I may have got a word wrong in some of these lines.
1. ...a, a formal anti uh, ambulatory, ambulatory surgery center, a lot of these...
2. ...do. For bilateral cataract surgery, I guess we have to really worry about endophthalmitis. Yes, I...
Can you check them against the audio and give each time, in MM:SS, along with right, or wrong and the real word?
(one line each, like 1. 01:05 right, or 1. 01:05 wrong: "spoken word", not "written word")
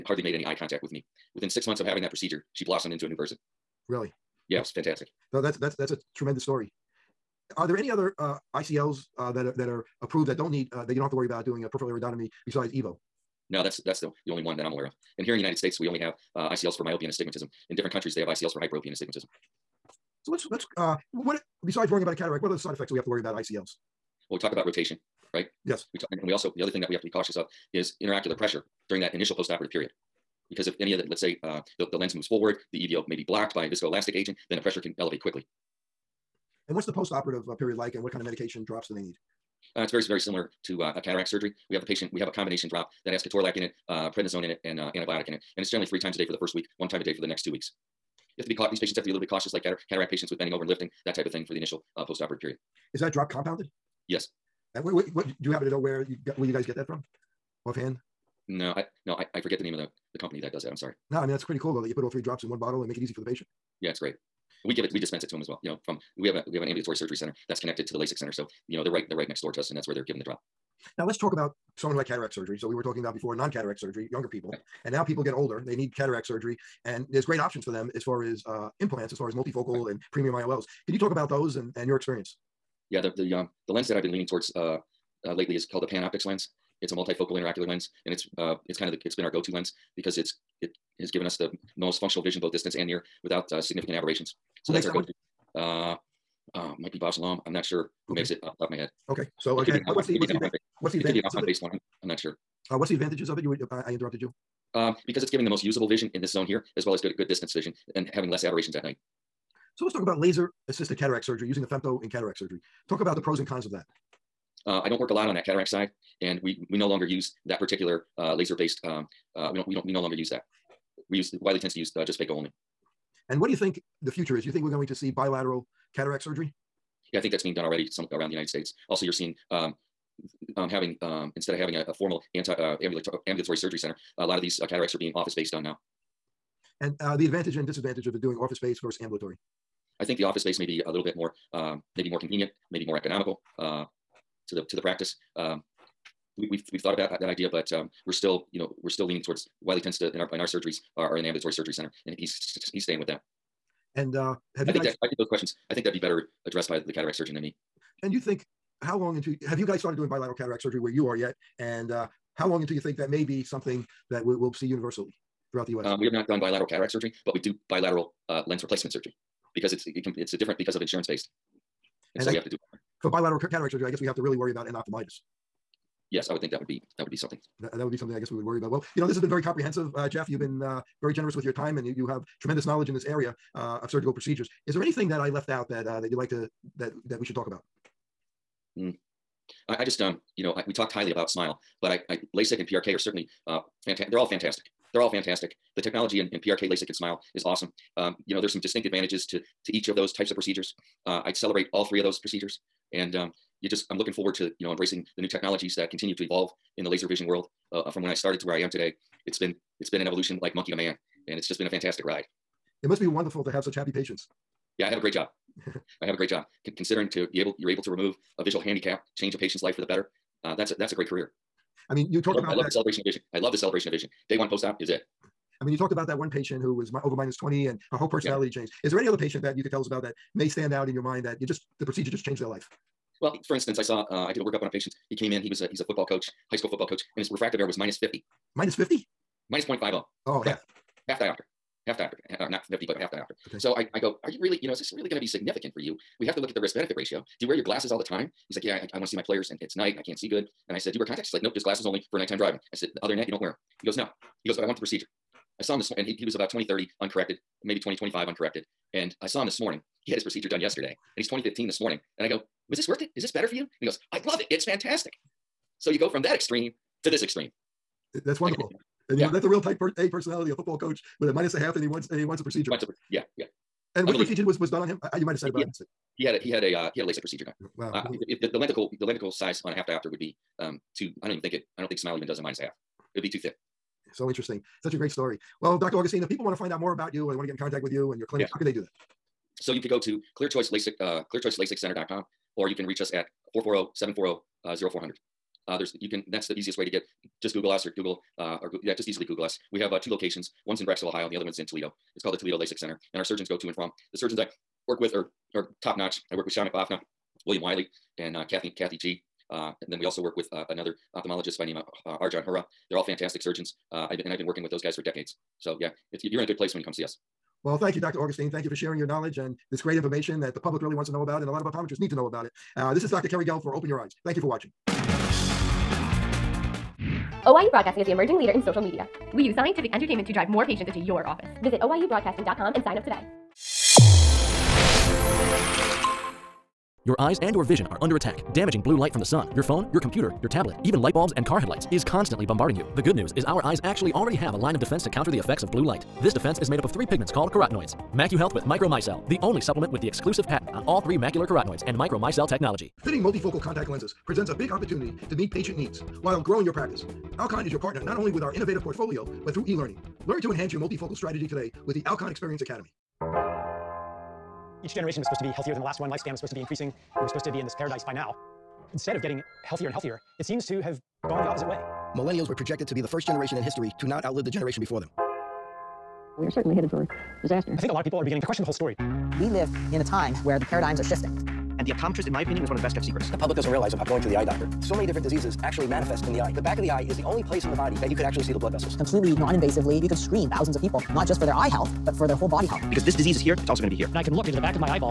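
1. 02:11 right
2. 02:52 right.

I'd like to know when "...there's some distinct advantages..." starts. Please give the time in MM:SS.
03:18.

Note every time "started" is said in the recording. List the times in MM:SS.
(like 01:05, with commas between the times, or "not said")
02:39, 03:28.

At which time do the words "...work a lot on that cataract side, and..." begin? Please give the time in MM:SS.
01:54.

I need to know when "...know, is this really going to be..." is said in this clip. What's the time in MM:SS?
04:04.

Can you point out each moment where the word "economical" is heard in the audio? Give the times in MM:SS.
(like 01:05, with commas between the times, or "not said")
02:22.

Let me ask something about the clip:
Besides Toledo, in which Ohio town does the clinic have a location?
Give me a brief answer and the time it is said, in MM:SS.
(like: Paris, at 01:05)
Brecksville, at 05:00.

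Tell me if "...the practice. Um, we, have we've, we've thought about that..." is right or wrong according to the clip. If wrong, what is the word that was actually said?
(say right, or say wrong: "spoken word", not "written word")
right.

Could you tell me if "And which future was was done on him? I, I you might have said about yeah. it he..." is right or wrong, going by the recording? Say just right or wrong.
wrong.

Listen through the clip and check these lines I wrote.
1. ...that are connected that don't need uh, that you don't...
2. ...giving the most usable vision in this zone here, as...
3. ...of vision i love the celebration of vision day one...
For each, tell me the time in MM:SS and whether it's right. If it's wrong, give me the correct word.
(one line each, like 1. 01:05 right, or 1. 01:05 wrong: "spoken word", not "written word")
1. 00:09 wrong: "approved", not "connected"
2. 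01:45 right
3. 03:43 right.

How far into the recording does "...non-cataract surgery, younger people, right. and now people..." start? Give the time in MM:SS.
01:13.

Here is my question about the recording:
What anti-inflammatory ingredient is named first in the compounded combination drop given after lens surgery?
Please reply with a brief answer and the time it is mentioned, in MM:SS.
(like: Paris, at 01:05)
ketorolac, at 00:43.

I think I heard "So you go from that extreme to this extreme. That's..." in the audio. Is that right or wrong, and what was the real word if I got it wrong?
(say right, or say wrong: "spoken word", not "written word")
right.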